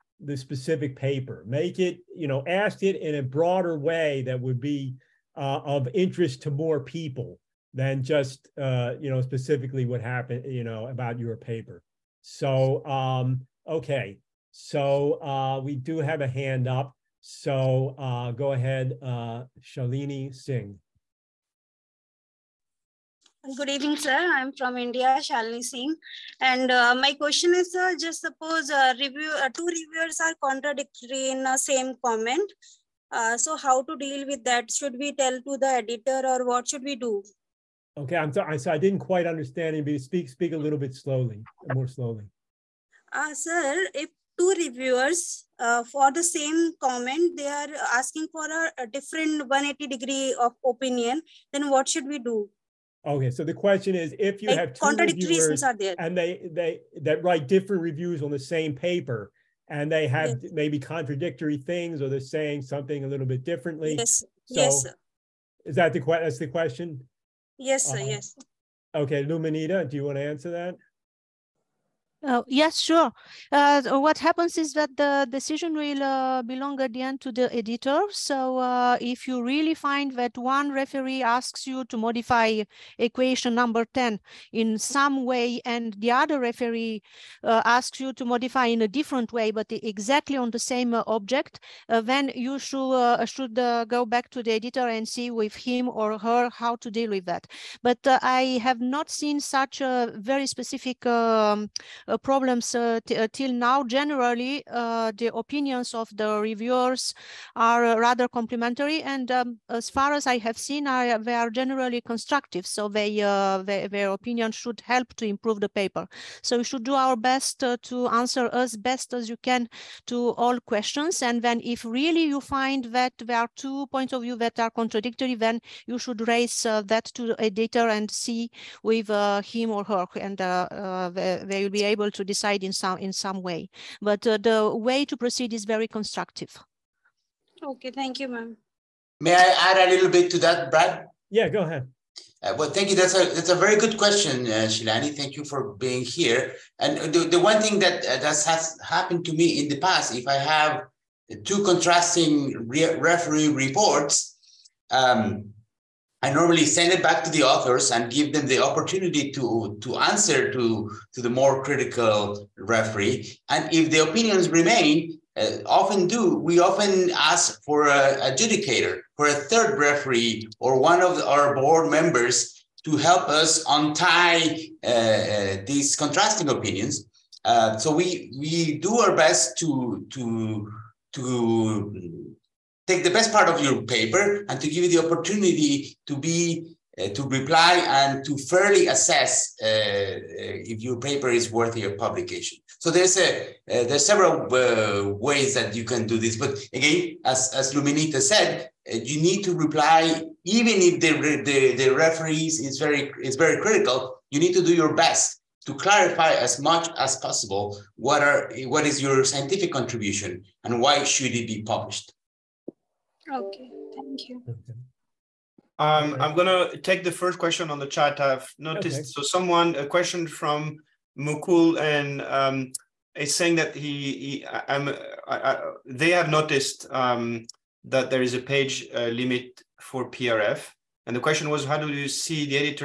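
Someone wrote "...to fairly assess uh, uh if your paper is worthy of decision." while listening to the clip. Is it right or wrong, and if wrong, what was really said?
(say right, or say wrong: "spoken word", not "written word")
wrong: "publication", not "decision".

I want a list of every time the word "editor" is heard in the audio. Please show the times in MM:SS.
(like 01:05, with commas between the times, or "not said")
00:35, 01:17, 01:34, 02:07.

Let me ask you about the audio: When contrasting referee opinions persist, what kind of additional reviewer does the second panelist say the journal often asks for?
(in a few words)
an adjudicator.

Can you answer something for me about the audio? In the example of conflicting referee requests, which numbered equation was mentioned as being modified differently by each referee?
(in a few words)
10.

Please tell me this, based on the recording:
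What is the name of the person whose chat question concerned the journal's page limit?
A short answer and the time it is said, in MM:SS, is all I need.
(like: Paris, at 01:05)
Mukul, at 03:41.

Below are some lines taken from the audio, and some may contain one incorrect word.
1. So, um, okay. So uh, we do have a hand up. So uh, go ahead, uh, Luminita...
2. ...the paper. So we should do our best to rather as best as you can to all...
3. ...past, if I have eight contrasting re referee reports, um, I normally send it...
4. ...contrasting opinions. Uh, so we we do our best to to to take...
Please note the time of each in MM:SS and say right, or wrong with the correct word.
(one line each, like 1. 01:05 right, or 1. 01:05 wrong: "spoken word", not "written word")
1. 00:12 wrong: "Shalini", not "Luminita"
2. 01:55 wrong: "answer", not "rather"
3. 02:29 wrong: "two", not "eight"
4. 02:55 right.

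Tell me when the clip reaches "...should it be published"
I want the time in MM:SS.
03:31.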